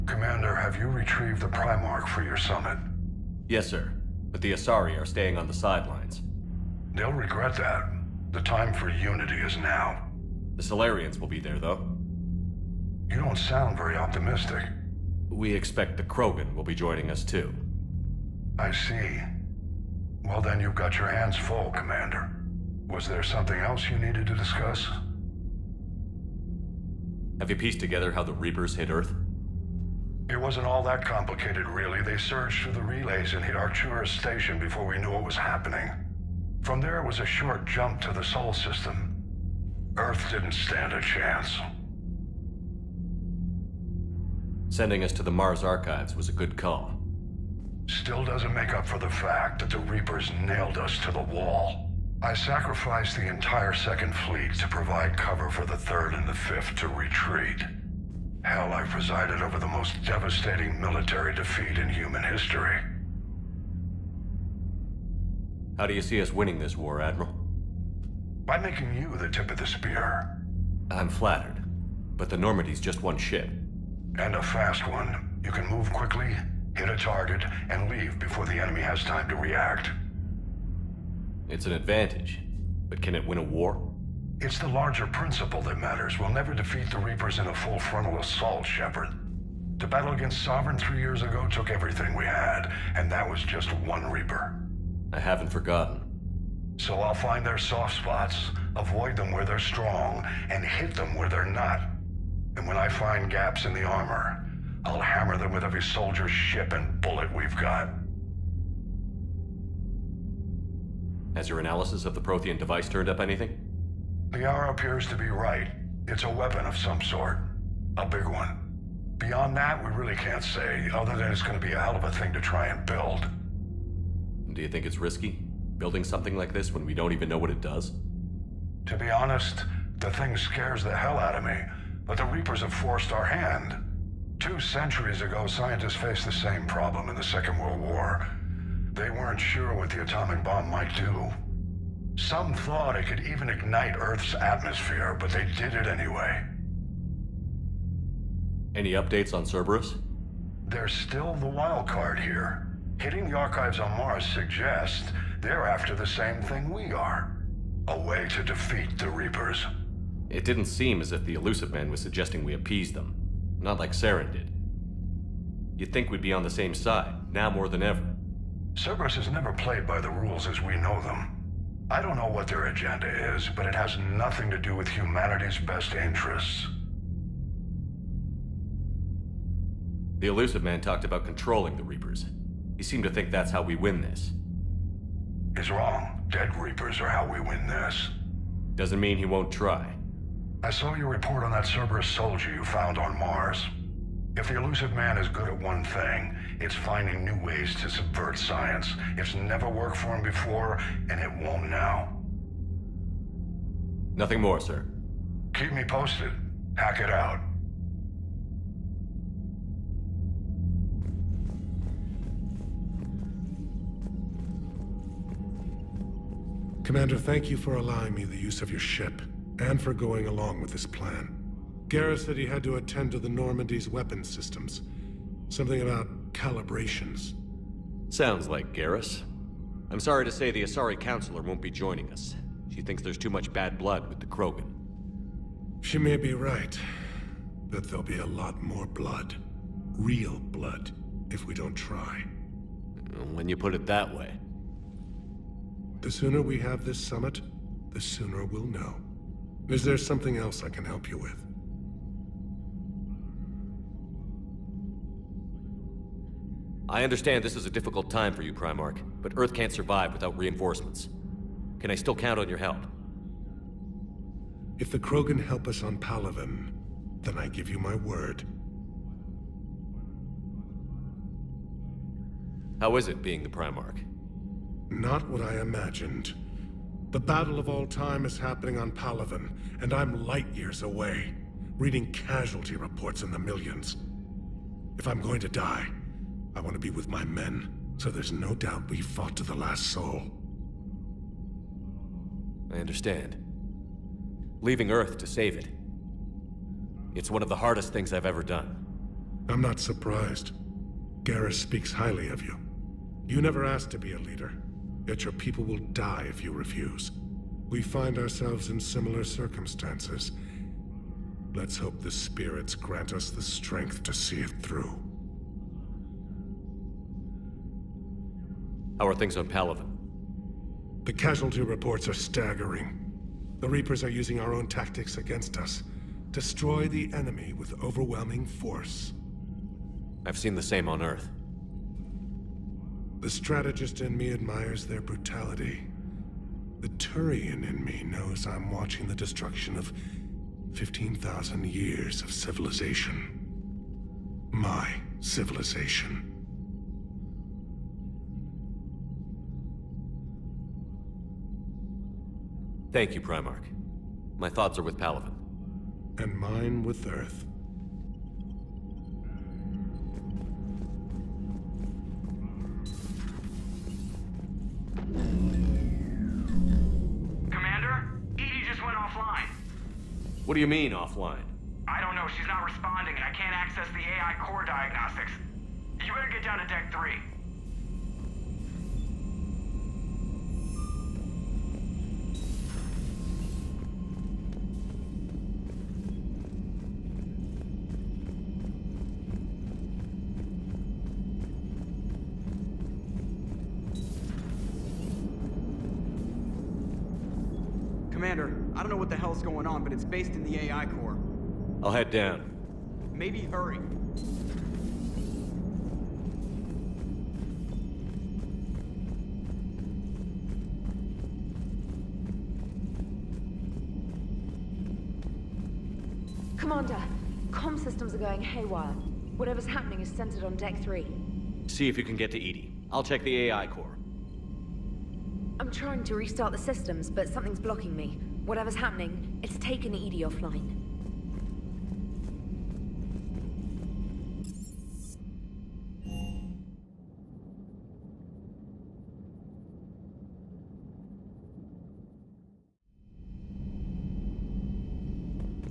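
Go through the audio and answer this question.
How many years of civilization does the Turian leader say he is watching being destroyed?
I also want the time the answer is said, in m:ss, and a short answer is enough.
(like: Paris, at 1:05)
15,000, at 5:40.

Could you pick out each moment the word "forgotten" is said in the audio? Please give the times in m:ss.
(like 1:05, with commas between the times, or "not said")
1:35.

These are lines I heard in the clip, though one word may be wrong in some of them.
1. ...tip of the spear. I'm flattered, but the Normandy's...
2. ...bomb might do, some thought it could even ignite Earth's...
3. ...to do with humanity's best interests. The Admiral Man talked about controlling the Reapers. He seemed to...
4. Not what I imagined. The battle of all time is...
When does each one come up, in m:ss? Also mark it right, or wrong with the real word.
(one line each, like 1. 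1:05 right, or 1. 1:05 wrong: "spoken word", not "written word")
1. 1:09 right
2. 2:20 right
3. 2:54 wrong: "Illusive", not "Admiral"
4. 4:34 right.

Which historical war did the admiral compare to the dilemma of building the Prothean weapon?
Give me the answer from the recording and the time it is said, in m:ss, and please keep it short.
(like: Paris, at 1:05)
Second World War, at 2:17.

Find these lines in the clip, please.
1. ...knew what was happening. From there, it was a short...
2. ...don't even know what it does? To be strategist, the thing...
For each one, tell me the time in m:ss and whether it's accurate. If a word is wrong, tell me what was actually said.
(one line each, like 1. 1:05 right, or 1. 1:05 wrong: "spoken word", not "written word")
1. 0:34 right
2. 2:06 wrong: "honest", not "strategist".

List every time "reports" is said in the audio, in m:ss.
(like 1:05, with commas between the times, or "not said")
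3:11, 4:42, 5:21.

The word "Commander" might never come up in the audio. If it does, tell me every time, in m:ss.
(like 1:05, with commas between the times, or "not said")
0:00, 0:21, 3:36, 6:07, 6:56.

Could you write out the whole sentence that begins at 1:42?
And when I find gaps in the armor, I'll hammer them with every soldier, ship, and bullet we've got.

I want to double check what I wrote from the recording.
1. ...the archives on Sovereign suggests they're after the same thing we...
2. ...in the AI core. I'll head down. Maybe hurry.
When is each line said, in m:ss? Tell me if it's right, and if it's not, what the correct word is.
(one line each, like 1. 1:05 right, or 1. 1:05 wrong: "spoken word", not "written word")
1. 2:33 wrong: "Mars", not "Sovereign"
2. 6:40 right.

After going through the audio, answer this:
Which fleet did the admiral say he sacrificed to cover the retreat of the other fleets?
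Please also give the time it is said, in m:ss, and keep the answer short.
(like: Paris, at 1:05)
Second Fleet, at 0:53.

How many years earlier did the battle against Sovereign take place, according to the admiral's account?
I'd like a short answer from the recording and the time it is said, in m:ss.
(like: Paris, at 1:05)
3, at 1:30.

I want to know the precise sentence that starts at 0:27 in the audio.
Have you pieced together how the Reapers hit Earth?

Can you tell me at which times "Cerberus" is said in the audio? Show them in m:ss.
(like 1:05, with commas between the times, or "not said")
2:29, 2:48, 3:11.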